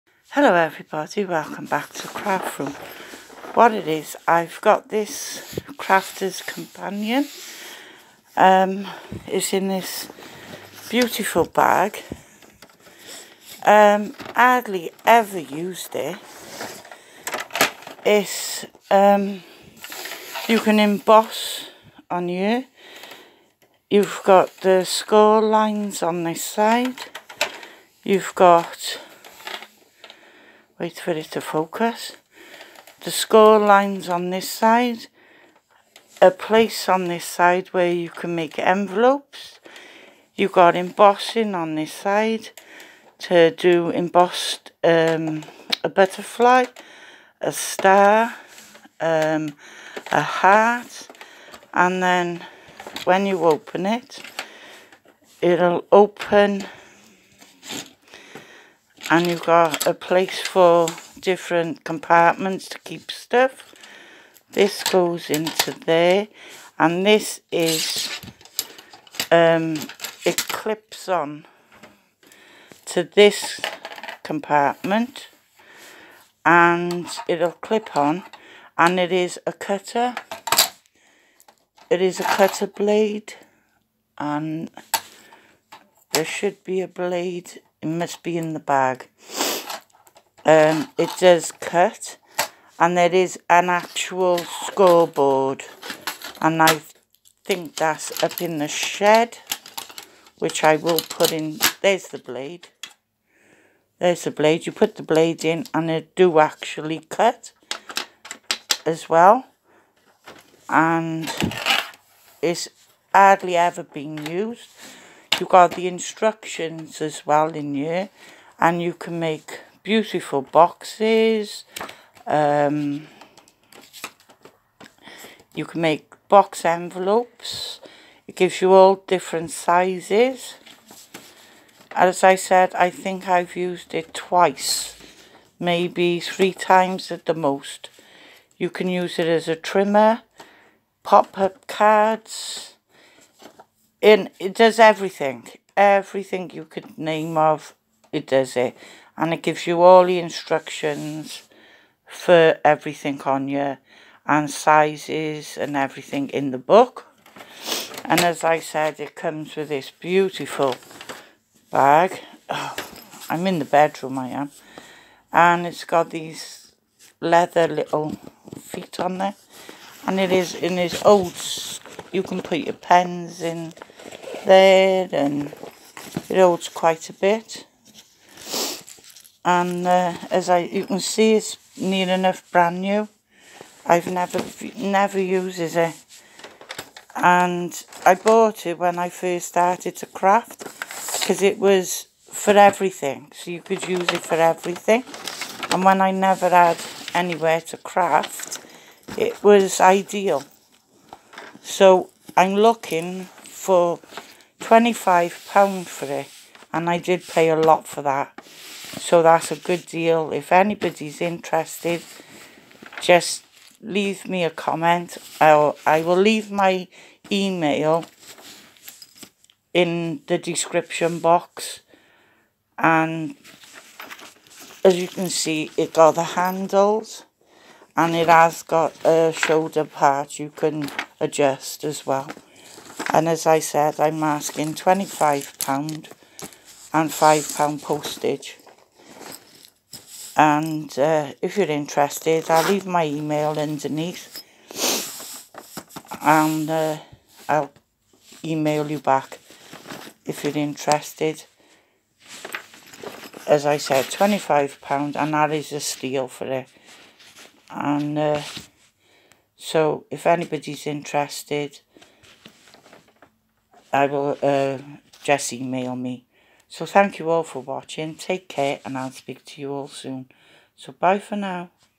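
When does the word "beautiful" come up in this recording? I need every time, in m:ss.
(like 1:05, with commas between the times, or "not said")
0:10, 1:59, 2:39.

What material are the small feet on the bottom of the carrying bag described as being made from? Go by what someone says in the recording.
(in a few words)
leather.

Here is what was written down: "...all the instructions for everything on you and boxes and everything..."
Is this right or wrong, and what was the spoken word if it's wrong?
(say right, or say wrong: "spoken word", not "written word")
wrong: "sizes", not "boxes".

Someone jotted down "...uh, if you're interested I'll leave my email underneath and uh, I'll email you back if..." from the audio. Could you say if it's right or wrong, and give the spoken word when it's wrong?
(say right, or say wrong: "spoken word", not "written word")
right.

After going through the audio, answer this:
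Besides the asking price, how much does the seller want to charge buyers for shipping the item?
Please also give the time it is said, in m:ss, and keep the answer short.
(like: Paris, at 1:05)
£5, at 3:57.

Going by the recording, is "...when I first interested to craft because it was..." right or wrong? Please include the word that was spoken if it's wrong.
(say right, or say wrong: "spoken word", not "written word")
wrong: "started", not "interested".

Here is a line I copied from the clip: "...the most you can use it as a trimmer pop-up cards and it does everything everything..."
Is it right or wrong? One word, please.
right.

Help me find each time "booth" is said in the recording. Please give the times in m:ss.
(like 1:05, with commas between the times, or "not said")
not said.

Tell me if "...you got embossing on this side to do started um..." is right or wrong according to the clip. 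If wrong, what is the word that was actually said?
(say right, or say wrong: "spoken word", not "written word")
wrong: "embossed", not "started".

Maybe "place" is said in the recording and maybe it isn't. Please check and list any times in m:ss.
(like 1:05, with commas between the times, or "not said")
0:36, 0:59.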